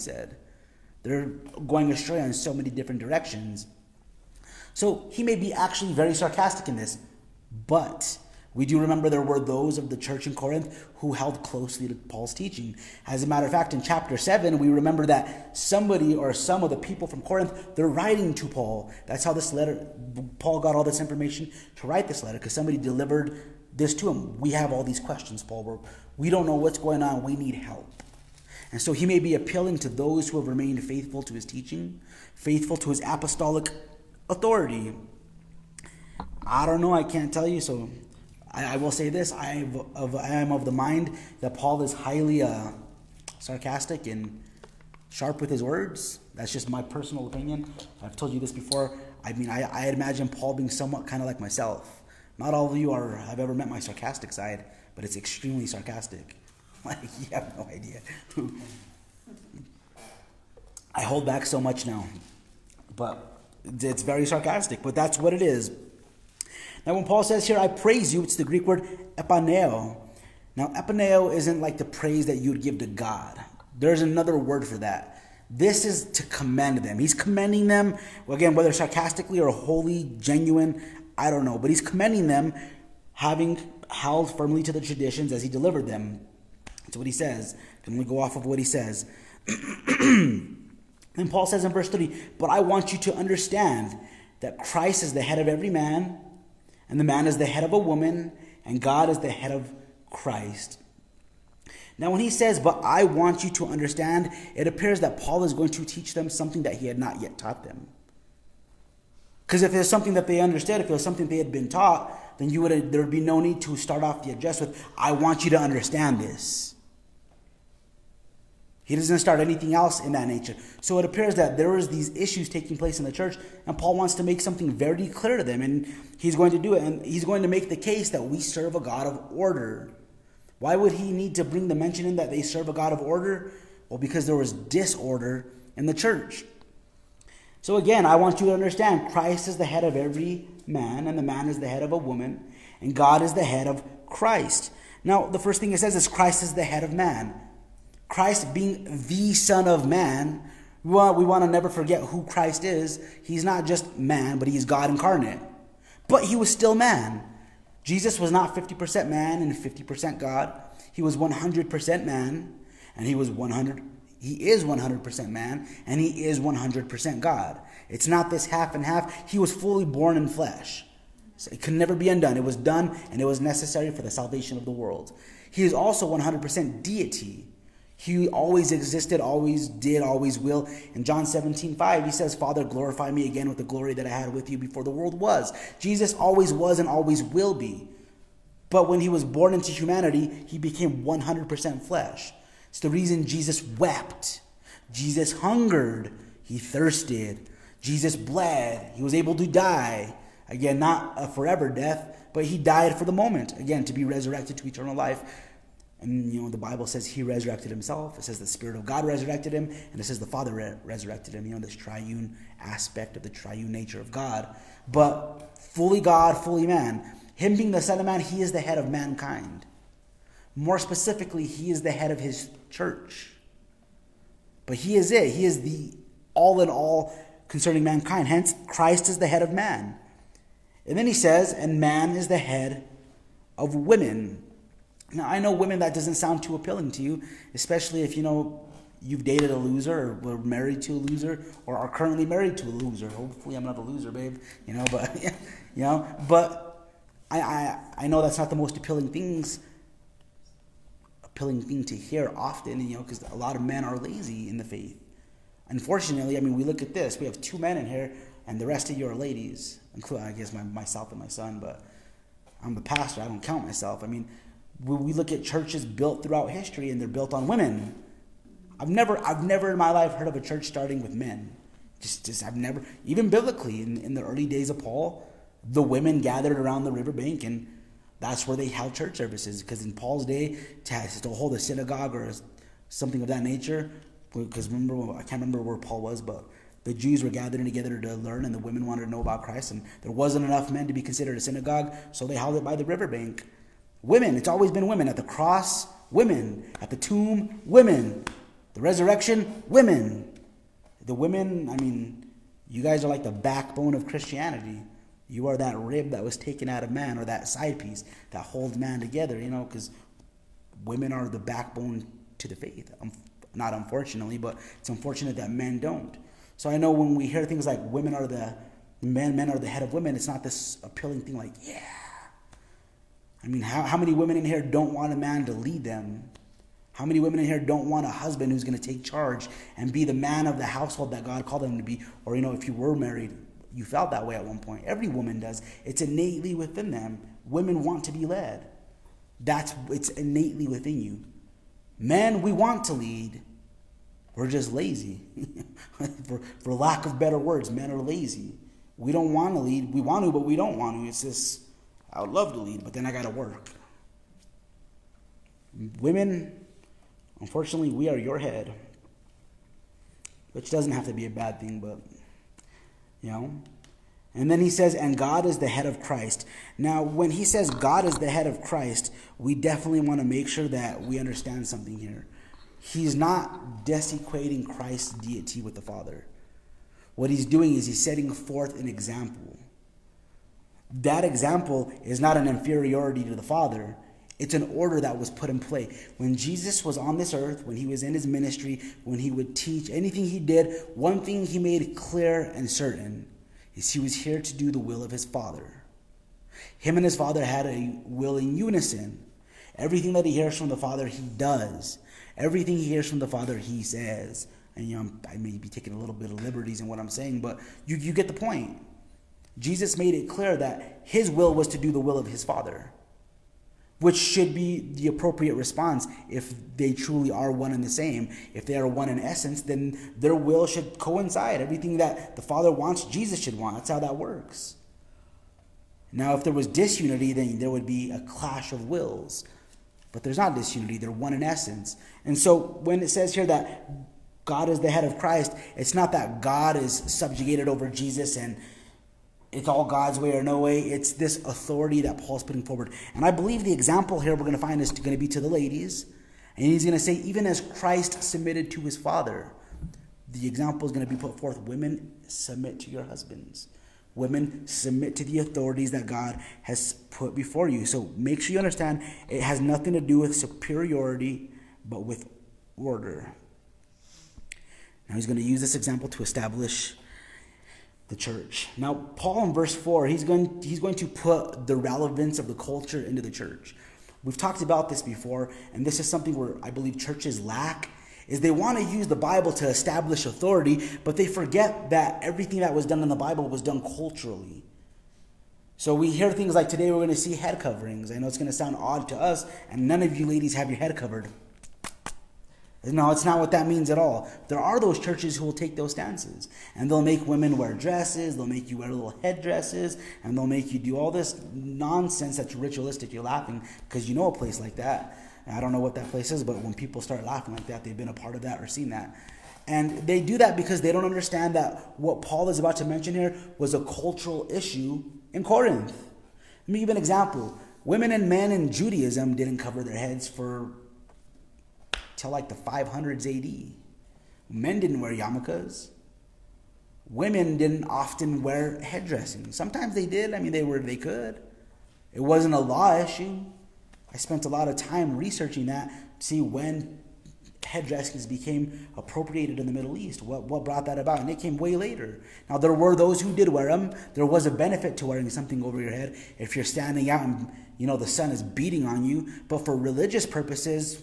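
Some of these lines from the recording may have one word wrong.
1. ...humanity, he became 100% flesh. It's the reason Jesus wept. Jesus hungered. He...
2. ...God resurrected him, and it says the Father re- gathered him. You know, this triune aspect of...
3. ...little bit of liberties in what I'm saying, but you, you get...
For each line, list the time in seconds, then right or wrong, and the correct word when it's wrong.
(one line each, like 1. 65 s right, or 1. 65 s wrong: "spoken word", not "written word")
1. 189 s right
2. 208 s wrong: "resurrected", not "gathered"
3. 405 s right.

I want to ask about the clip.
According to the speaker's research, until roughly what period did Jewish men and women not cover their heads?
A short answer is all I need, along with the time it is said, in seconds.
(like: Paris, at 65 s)
The 500s AD, at 522 s.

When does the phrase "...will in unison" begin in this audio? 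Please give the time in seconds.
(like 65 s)
398 s.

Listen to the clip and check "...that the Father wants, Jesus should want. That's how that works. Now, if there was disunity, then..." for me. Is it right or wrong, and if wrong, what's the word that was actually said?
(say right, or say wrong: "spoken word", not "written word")
right.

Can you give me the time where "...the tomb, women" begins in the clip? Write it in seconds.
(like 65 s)
296 s.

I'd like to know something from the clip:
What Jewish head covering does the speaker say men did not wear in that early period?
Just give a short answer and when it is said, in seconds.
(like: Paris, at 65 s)
Yarmulkes, at 525 s.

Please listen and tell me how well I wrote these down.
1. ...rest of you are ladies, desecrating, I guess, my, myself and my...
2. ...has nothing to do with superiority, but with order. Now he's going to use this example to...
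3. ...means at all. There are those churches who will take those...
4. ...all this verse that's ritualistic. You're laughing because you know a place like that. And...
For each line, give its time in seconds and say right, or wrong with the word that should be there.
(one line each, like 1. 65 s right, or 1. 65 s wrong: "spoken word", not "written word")
1. 258 s wrong: "including", not "desecrating"
2. 459 s right
3. 493 s right
4. 500 s wrong: "nonsense", not "verse".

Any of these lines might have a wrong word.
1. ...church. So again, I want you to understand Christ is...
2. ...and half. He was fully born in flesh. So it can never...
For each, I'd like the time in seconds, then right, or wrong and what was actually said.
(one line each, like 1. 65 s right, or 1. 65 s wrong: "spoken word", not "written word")
1. 135 s right
2. 168 s right.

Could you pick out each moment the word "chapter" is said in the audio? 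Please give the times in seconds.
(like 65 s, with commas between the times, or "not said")
13 s.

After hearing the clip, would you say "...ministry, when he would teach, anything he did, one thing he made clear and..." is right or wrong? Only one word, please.
right.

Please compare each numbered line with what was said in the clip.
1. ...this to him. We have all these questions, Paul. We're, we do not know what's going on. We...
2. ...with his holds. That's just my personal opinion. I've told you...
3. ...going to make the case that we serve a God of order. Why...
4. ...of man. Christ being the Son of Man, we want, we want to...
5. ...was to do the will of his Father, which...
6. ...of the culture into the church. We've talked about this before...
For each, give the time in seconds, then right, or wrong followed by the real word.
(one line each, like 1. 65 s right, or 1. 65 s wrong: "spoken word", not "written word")
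1. 23 s right
2. 45 s wrong: "words", not "holds"
3. 127 s right
4. 146 s right
5. 411 s right
6. 472 s right.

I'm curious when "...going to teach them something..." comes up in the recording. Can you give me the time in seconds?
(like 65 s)
105 s.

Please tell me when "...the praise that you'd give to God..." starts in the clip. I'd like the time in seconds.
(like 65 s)
71 s.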